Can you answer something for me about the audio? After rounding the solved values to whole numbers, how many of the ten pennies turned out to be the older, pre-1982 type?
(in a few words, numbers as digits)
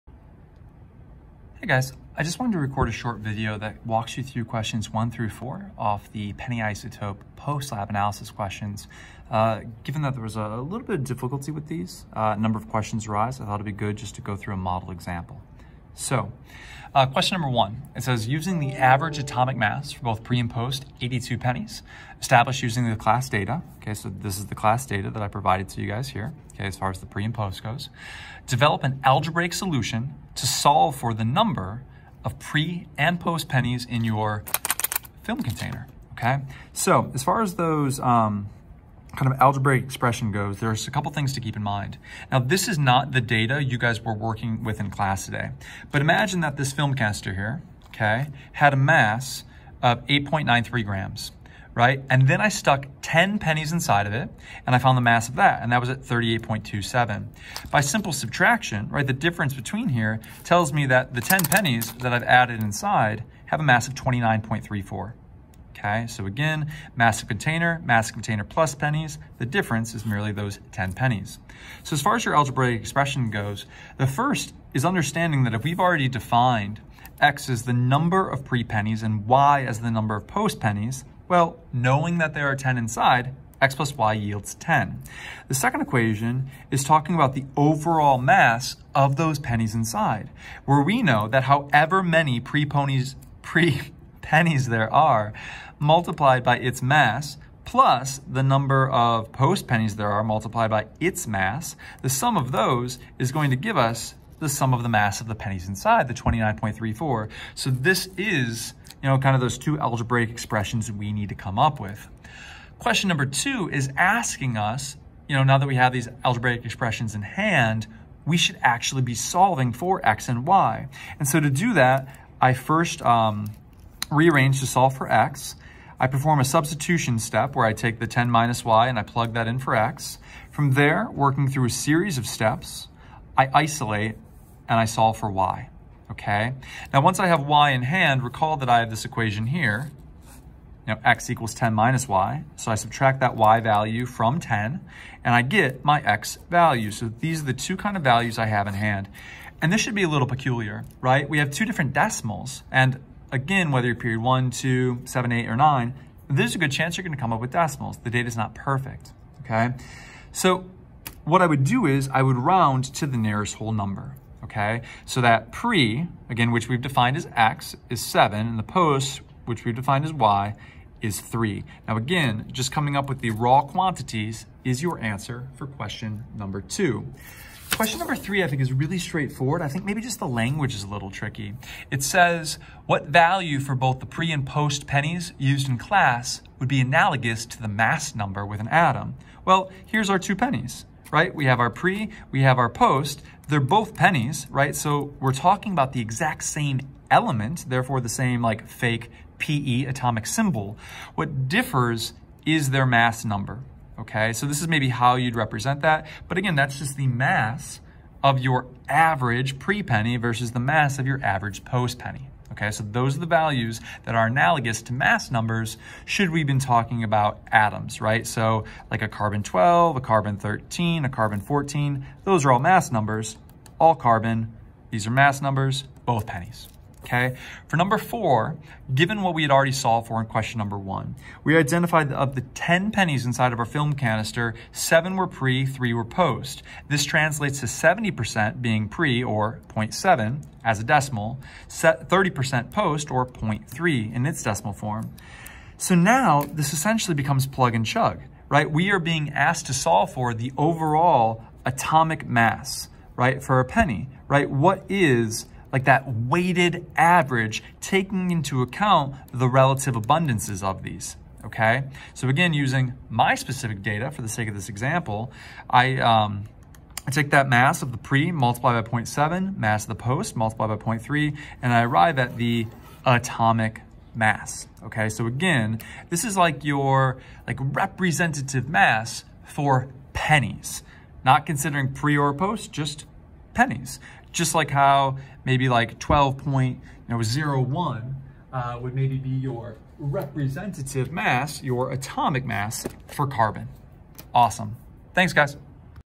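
7.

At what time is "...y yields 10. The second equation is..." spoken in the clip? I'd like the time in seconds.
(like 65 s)
83 s.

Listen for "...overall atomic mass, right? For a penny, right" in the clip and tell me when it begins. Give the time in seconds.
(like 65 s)
250 s.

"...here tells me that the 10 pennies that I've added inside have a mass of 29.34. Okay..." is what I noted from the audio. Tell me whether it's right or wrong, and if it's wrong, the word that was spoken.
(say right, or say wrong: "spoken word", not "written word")
right.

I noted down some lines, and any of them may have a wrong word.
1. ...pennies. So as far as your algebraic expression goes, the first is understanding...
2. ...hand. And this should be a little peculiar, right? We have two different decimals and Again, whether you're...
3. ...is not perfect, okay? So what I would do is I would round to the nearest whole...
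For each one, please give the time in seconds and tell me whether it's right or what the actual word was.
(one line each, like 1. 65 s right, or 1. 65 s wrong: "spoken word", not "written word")
1. 70 s right
2. 148 s right
3. 158 s right.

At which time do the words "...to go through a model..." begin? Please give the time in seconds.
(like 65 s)
14 s.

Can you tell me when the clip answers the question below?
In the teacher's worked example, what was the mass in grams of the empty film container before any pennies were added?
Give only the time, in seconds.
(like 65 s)
50 s.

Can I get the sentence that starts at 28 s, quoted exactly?
Develop an algebraic solution to solve for the number of pre and post pennies in your film container.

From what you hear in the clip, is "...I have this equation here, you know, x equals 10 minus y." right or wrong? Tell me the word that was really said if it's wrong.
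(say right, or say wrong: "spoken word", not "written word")
right.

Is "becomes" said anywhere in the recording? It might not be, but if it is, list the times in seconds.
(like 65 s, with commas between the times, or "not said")
247 s.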